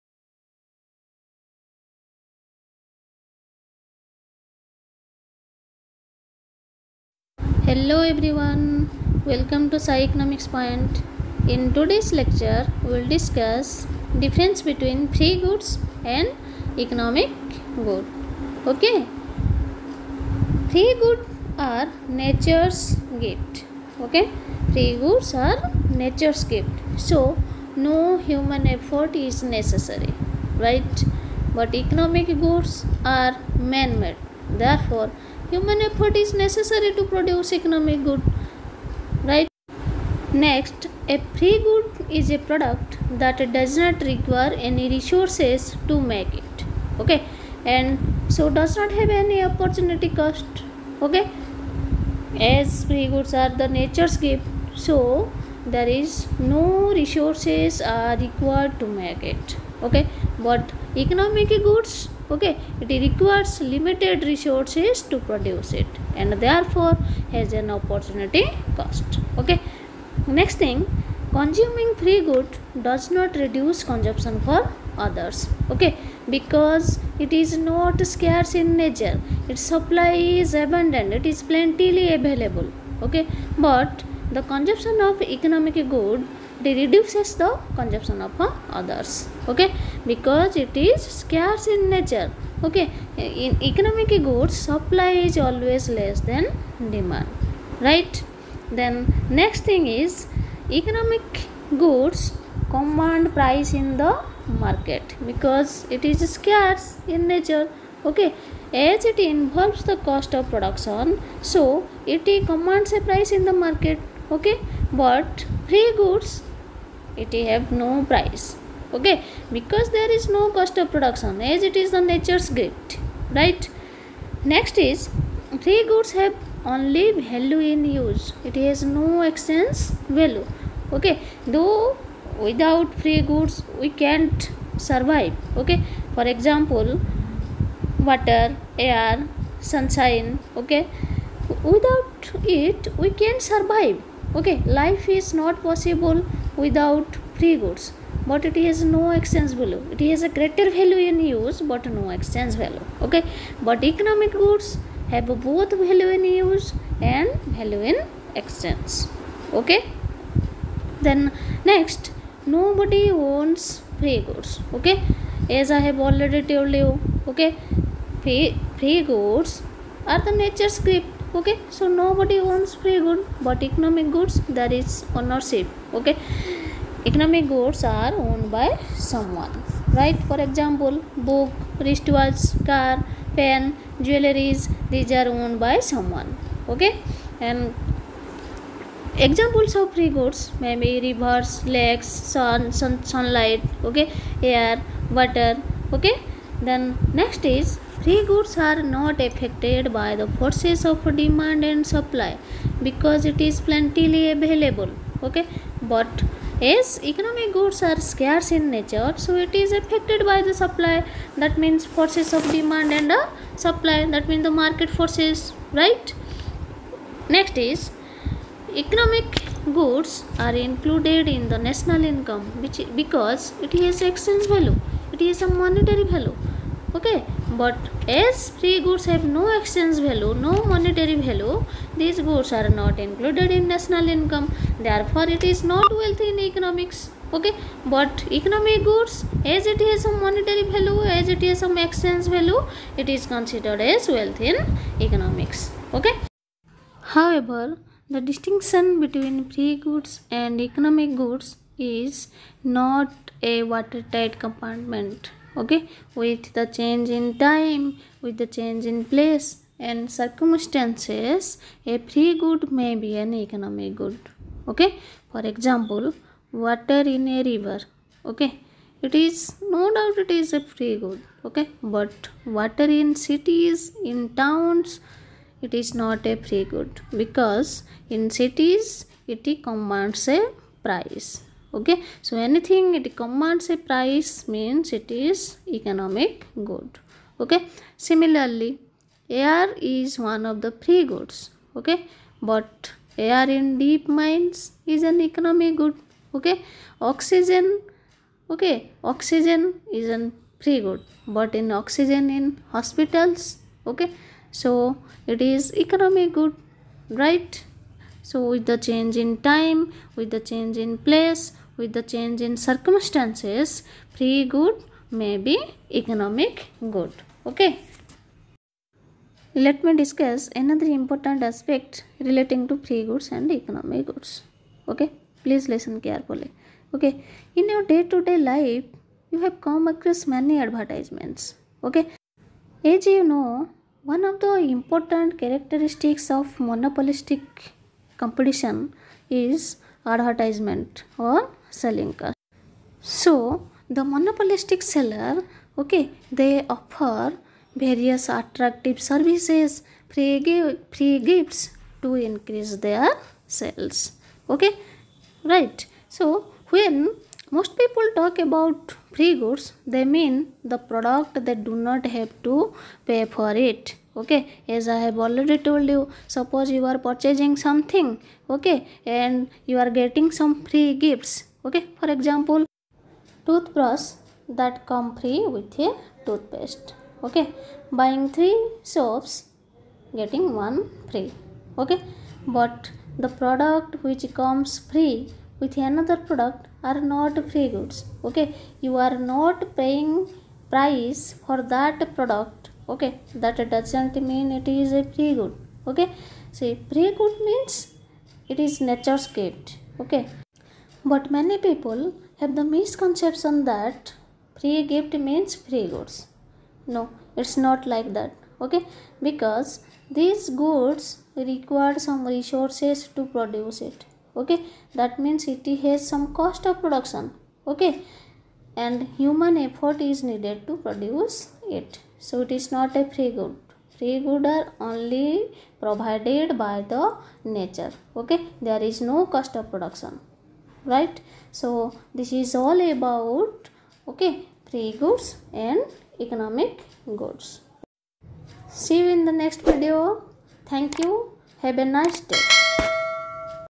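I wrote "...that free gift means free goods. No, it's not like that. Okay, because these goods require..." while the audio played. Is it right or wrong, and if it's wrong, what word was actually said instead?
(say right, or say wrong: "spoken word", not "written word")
right.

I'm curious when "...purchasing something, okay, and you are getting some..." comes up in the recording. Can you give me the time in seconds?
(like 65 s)
366 s.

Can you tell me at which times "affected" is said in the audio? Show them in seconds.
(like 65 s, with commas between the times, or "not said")
199 s, 209 s.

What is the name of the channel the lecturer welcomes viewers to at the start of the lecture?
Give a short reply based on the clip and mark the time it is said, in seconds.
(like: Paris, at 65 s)
Economics point, at 9 s.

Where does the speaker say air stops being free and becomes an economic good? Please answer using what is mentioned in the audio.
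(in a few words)
in deep mines.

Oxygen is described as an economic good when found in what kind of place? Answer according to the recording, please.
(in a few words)
hospitals.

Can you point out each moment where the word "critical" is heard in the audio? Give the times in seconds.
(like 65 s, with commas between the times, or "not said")
not said.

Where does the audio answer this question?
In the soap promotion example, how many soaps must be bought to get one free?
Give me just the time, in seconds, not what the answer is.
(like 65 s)
377 s.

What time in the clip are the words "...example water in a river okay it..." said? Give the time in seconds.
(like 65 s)
265 s.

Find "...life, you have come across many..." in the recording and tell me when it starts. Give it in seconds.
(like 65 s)
328 s.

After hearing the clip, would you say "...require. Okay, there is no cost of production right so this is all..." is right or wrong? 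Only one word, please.
wrong.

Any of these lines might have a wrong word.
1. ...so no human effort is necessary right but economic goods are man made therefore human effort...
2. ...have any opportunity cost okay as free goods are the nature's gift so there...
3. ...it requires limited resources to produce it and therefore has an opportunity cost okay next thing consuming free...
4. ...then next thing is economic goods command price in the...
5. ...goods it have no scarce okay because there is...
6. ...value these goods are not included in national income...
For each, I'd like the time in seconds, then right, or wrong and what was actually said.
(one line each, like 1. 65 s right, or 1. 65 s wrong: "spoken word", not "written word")
1. 27 s right
2. 48 s right
3. 62 s right
4. 98 s right
5. 115 s wrong: "price", not "scarce"
6. 231 s right.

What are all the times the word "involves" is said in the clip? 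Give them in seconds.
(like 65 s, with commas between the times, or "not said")
109 s.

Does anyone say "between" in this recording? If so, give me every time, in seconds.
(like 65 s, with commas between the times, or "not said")
14 s, 249 s.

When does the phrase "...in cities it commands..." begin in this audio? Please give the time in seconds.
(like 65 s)
278 s.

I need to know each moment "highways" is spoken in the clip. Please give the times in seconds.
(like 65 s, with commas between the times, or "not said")
not said.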